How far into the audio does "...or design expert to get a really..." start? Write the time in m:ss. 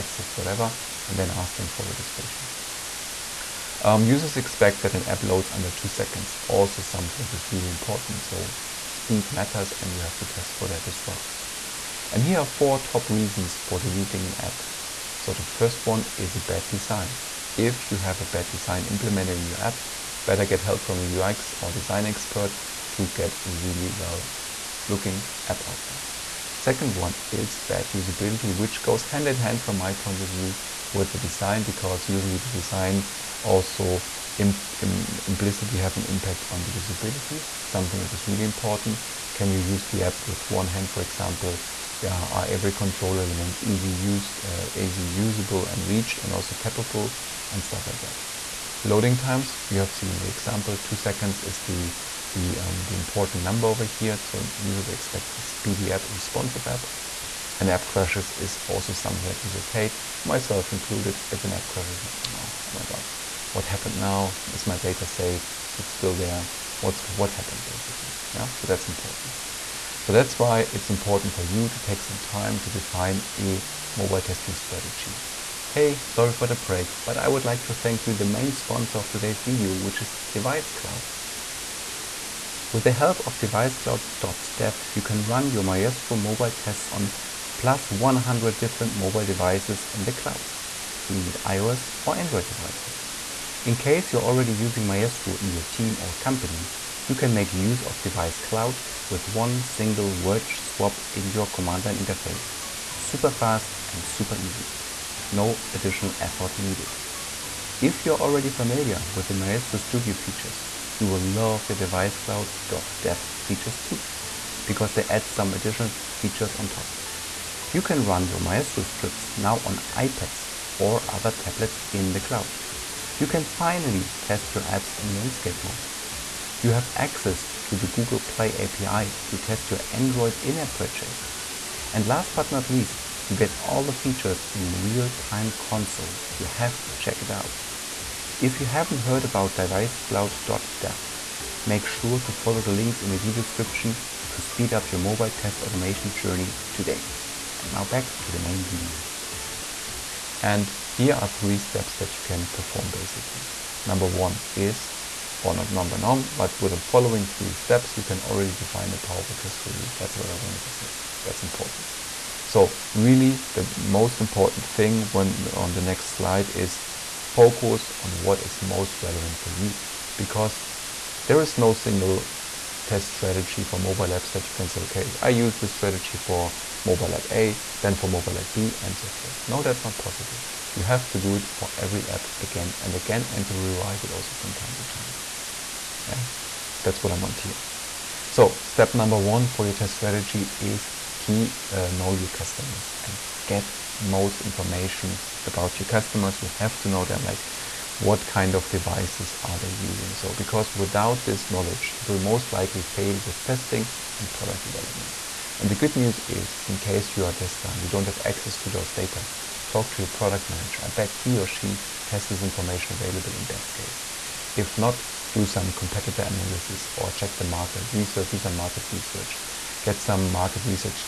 0:21.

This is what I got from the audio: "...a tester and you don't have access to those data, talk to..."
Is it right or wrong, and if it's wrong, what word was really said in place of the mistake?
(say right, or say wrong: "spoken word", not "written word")
right.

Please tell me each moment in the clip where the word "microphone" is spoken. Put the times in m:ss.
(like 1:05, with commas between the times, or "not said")
not said.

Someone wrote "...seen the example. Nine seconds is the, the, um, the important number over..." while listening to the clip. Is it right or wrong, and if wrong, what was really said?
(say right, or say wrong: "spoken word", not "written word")
wrong: "Two", not "Nine".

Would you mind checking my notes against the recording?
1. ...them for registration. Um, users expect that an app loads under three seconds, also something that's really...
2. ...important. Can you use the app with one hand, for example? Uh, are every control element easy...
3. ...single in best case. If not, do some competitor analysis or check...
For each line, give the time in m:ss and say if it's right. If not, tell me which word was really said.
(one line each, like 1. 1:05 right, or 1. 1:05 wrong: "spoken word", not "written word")
1. 0:01 wrong: "two", not "three"
2. 0:38 right
3. 3:32 wrong: "available", not "single".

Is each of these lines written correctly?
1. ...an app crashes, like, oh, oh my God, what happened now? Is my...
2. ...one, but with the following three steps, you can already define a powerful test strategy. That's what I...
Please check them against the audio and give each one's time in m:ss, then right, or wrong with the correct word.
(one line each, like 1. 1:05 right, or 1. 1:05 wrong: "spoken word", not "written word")
1. 1:01 right
2. 2:35 right.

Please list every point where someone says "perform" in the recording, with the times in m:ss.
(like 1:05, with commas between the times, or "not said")
2:32.